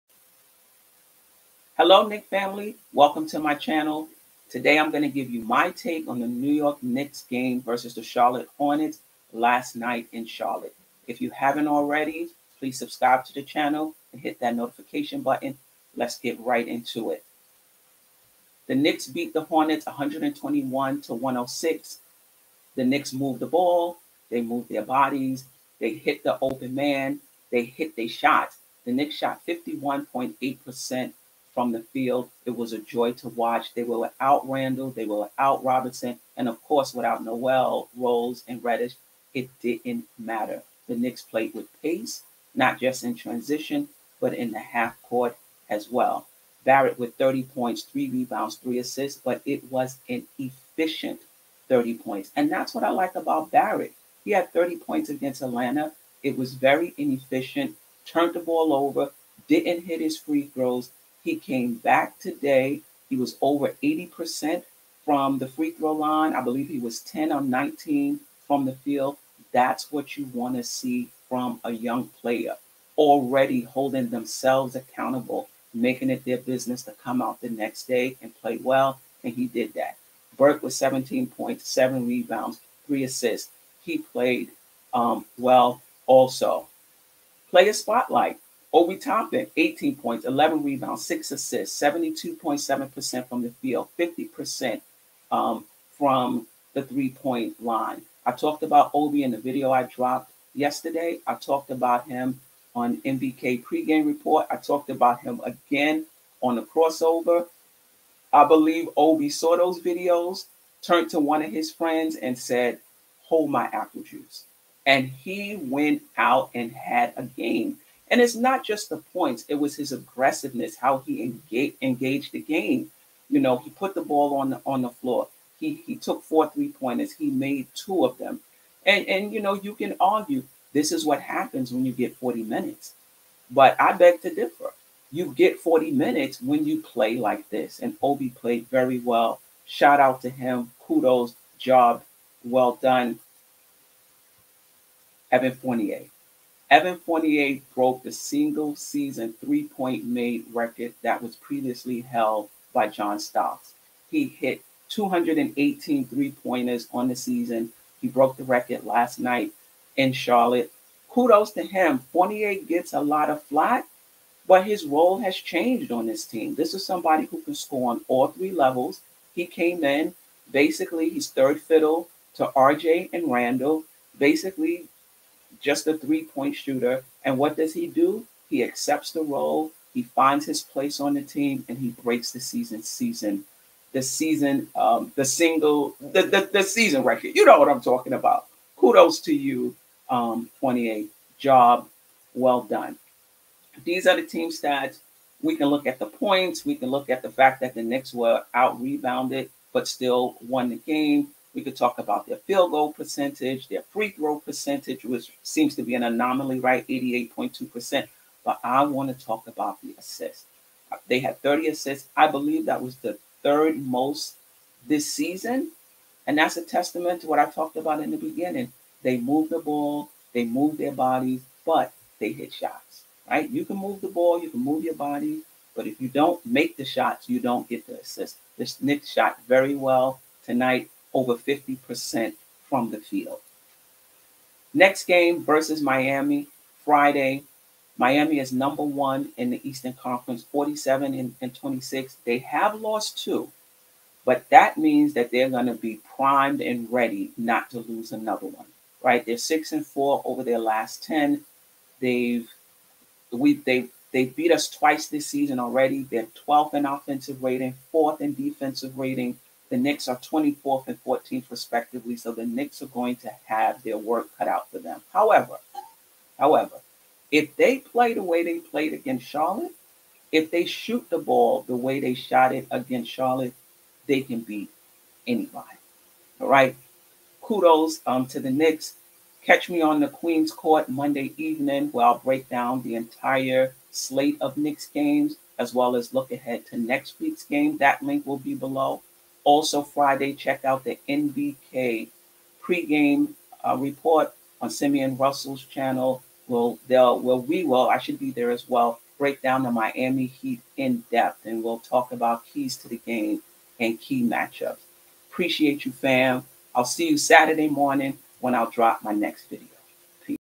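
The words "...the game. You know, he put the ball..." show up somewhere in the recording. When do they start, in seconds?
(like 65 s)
122 s.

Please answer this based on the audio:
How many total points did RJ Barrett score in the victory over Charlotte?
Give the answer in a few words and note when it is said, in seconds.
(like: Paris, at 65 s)
30 points, at 46 s.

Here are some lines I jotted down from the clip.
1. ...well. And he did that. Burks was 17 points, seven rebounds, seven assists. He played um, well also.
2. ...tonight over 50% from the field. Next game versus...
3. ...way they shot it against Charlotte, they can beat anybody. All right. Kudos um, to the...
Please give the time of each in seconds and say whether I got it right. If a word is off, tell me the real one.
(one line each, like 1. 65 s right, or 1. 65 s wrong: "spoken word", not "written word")
1. 78 s wrong: "three", not "seven"
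2. 230 s right
3. 271 s right.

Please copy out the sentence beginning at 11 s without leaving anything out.
If you haven't already, please subscribe to the channel and hit that notification button.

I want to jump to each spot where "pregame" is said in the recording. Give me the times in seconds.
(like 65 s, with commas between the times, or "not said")
103 s, 292 s.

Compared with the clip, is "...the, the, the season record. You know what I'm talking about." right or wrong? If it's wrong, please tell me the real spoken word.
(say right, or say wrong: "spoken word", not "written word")
right.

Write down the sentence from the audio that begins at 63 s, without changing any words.
He was over 80% from the free throw line.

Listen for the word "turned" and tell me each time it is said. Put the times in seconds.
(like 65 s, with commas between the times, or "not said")
58 s, 110 s.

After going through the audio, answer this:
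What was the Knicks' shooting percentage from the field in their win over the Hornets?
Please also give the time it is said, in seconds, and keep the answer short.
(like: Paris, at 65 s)
51.8%, at 29 s.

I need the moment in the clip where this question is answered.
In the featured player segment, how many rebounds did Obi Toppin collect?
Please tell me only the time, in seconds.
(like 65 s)
90 s.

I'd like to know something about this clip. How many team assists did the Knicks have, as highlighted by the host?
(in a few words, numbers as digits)
30.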